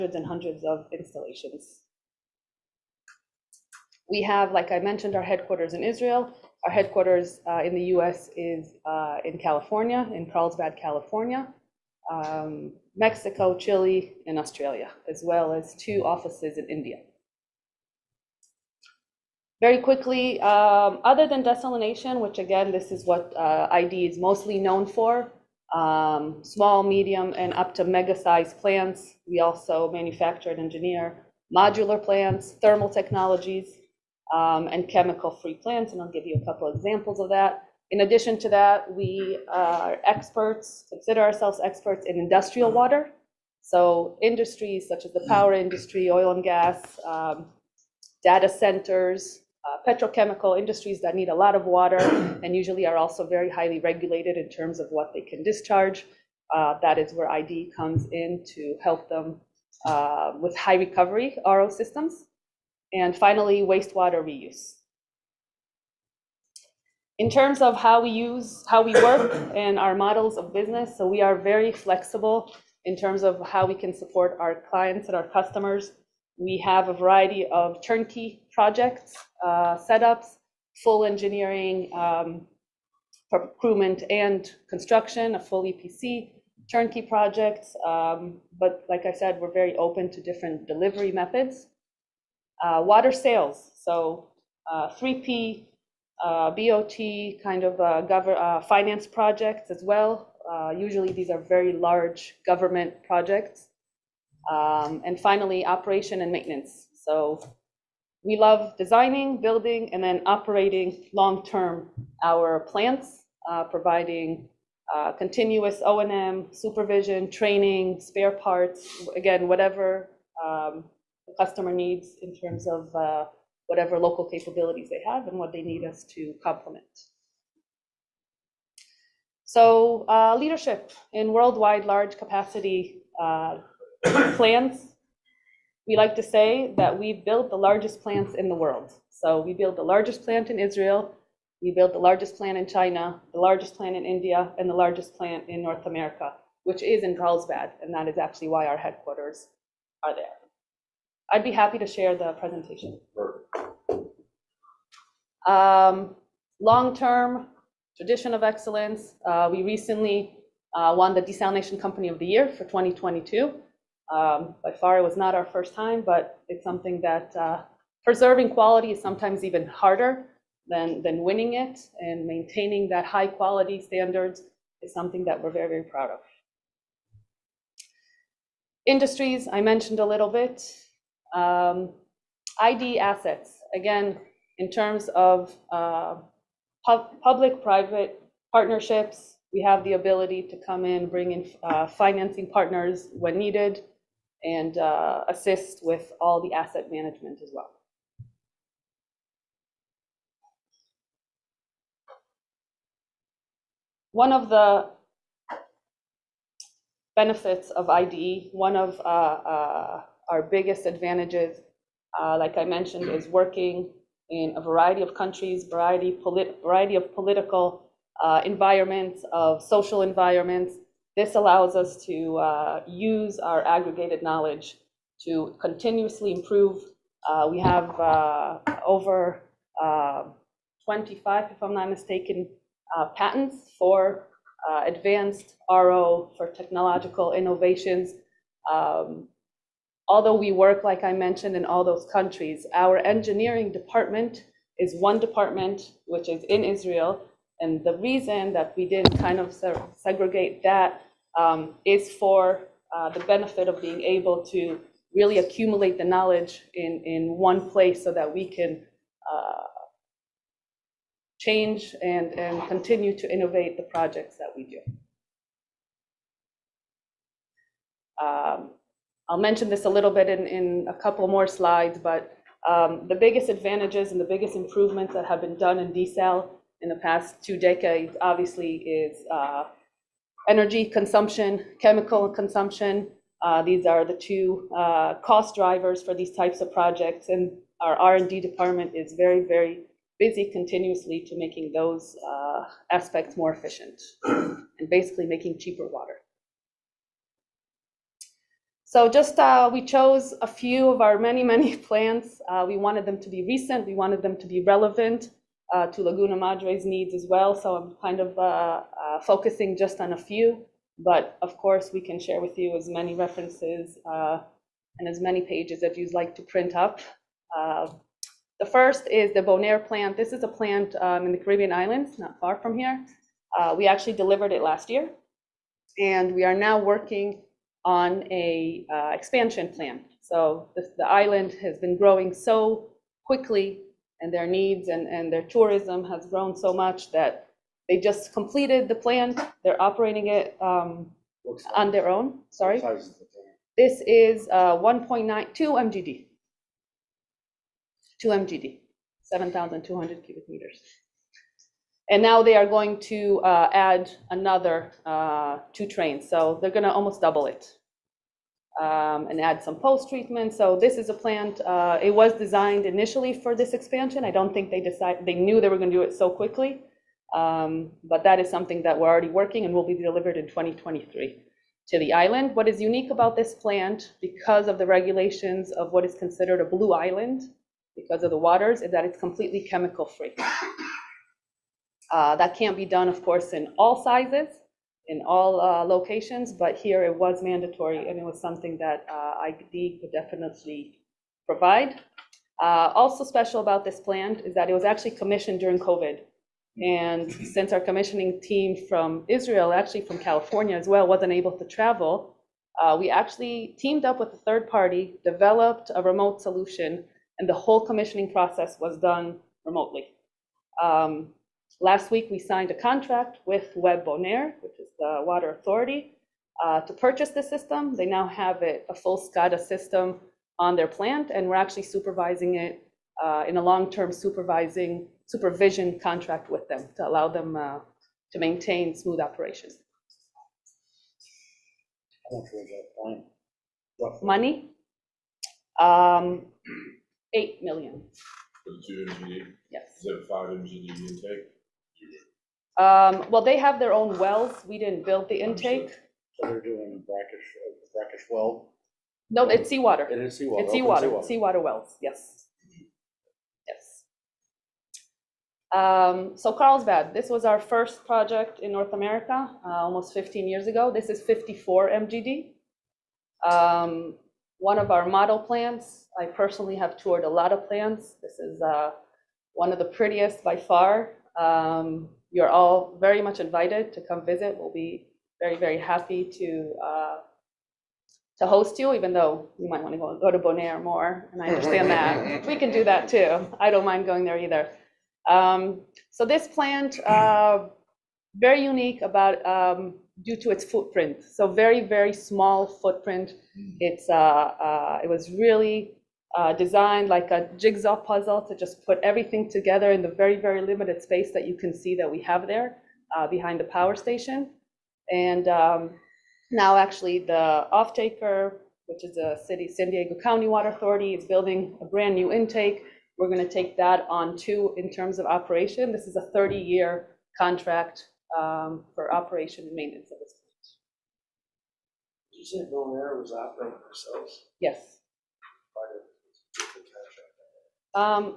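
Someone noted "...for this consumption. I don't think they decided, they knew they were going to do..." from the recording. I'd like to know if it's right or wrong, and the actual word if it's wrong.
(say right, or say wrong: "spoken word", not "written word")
wrong: "expansion", not "consumption".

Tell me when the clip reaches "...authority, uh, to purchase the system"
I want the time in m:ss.
6:55.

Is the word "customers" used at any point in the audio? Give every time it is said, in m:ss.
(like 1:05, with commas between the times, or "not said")
1:15, 2:01.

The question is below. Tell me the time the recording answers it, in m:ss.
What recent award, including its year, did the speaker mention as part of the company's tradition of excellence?
2:41.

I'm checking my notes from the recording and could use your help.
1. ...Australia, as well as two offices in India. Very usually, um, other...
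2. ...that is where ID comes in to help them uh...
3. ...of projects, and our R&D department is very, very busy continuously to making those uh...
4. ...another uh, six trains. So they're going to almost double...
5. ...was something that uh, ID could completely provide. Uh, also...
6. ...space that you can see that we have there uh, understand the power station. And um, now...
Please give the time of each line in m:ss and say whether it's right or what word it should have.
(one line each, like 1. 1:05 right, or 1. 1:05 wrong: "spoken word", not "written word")
1. 0:14 wrong: "quickly", not "usually"
2. 0:56 right
3. 4:46 right
4. 5:54 wrong: "two", not "six"
5. 6:28 wrong: "definitely", not "completely"
6. 8:21 wrong: "behind", not "understand".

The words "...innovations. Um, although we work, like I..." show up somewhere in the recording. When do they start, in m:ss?
3:57.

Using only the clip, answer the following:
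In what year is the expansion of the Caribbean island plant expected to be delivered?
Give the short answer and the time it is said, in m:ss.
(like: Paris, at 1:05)
2023, at 6:10.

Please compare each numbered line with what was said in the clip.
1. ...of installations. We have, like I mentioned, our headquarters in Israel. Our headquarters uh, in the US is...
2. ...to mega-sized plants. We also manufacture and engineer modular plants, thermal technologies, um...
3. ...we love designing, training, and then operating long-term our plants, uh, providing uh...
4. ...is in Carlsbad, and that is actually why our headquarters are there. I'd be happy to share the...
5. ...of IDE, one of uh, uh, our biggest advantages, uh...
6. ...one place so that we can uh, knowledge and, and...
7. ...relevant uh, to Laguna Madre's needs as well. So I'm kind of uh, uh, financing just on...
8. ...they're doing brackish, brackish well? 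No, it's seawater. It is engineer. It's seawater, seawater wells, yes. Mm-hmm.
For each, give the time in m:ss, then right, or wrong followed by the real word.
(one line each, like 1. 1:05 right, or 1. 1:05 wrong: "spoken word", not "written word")
1. 0:00 right
2. 0:27 right
3. 1:48 wrong: "building", not "training"
4. 2:26 right
5. 3:27 right
6. 4:17 wrong: "change", not "knowledge"
7. 5:04 wrong: "focusing", not "financing"
8. 7:26 wrong: "seawater", not "engineer".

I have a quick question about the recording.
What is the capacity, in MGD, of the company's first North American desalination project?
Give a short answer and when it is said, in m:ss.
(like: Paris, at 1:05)
54 MGD, at 7:41.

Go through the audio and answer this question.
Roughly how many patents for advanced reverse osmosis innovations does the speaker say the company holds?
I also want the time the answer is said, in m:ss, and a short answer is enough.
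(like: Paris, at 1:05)
25, at 3:50.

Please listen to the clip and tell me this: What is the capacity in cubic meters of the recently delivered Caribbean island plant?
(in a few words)
7,200 cubic meters.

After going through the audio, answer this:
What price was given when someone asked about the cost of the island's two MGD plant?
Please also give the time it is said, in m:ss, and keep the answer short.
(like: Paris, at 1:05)
8 million, at 7:17.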